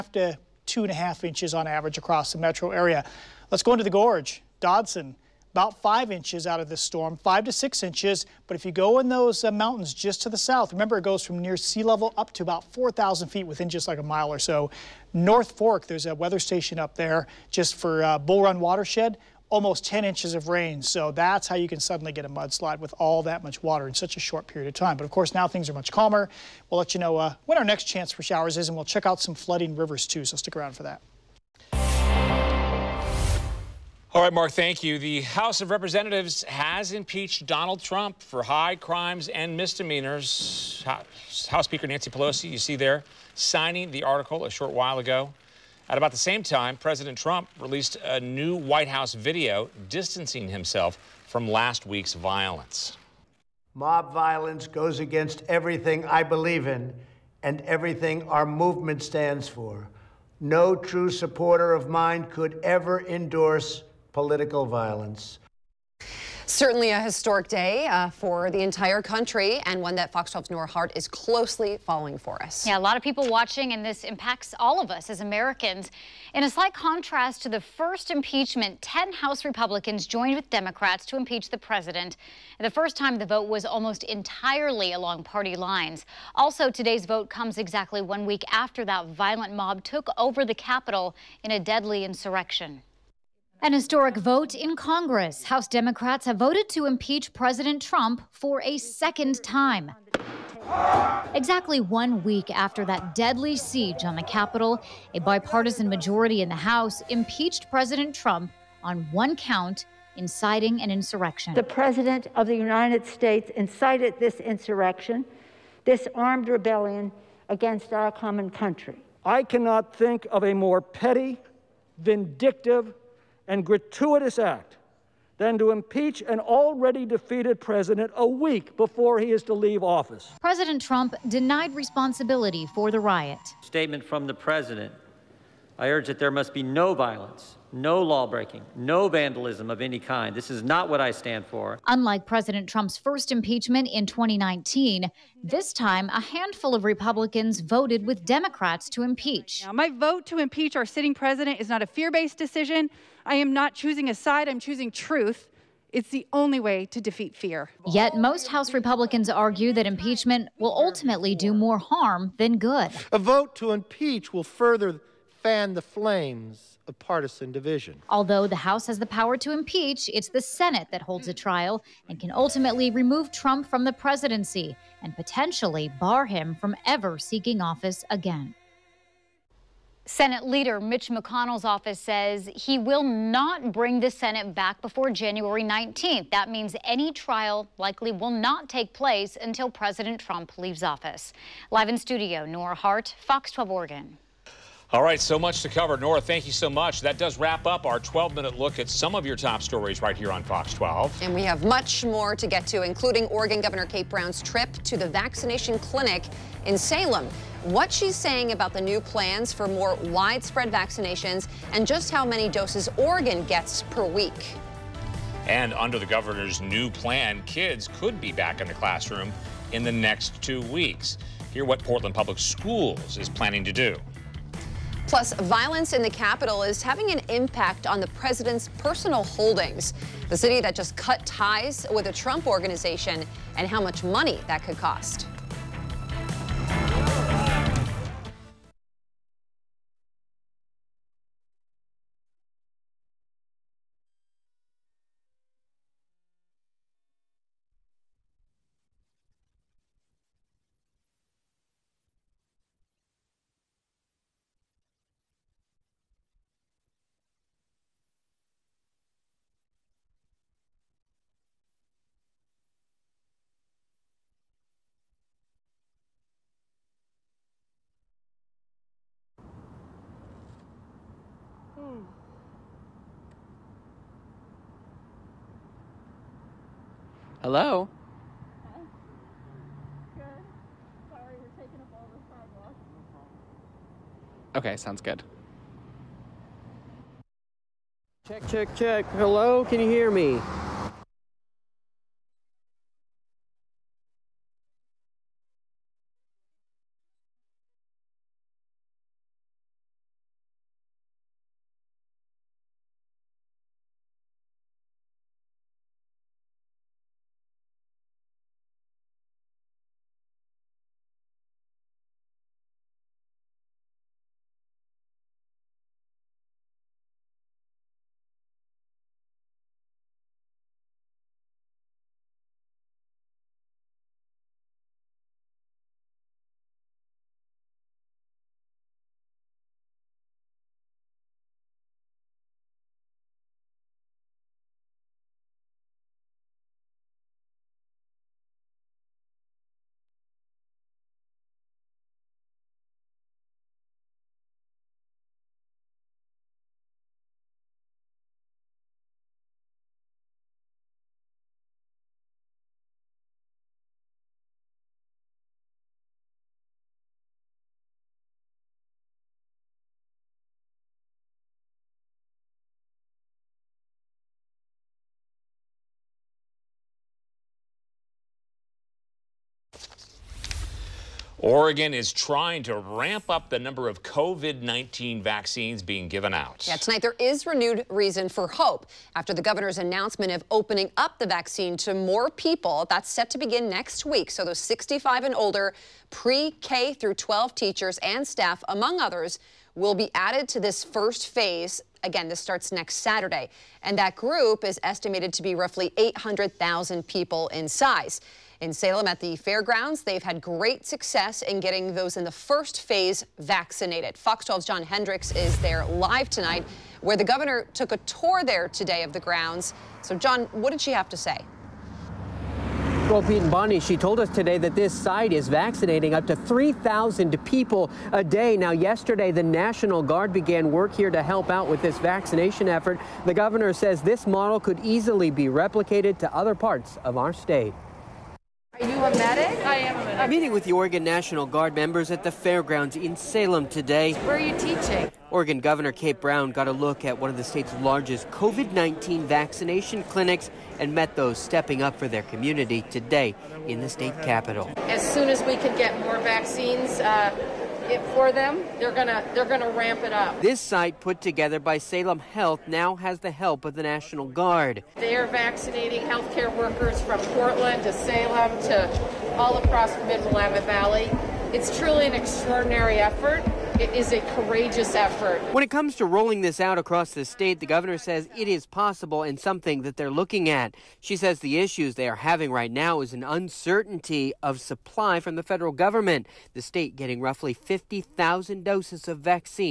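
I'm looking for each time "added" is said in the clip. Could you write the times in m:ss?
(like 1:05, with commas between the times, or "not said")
6:30.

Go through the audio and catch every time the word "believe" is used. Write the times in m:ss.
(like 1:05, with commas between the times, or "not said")
0:56.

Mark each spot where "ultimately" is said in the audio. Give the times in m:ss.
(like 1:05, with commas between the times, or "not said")
2:40, 2:52.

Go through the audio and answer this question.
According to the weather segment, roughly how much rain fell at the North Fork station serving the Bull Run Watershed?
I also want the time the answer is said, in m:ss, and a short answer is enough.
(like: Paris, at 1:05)
almost 10 inches, at 0:19.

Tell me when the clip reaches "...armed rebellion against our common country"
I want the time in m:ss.
1:56.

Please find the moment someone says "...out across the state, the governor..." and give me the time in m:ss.
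7:46.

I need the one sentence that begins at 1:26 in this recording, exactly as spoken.
Also, today's vote comes exactly one week after that violent mob took over the Capitol in a deadly insurrection.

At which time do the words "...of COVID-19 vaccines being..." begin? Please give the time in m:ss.
6:13.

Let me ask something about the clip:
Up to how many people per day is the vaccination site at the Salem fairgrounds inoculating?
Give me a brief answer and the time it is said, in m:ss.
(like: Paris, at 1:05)
3,000, at 6:56.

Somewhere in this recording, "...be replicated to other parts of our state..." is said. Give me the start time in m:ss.
7:05.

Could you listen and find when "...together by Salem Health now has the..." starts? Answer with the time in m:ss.
7:31.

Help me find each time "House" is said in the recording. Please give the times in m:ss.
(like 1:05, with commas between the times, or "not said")
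0:35, 0:40, 0:48, 1:19, 1:35, 1:46, 2:38, 2:48.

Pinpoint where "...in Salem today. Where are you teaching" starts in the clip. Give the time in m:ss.
7:12.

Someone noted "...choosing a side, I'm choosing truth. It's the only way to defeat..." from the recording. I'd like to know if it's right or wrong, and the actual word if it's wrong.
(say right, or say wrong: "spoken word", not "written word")
right.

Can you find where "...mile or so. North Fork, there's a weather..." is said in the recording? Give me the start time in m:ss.
0:14.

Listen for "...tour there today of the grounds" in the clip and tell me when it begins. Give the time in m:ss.
6:47.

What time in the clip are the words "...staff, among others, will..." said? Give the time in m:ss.
6:28.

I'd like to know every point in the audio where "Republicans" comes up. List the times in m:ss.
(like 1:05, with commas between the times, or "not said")
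1:19, 2:26, 2:38.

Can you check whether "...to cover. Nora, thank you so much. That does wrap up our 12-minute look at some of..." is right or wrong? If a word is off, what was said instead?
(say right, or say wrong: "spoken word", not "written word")
right.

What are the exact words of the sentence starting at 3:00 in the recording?
Senate leader Mitch McConnell's office says he will not bring the Senate back before January 19th.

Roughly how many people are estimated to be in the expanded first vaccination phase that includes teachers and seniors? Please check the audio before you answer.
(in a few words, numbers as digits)
800,000.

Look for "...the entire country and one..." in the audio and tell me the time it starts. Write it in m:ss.
1:08.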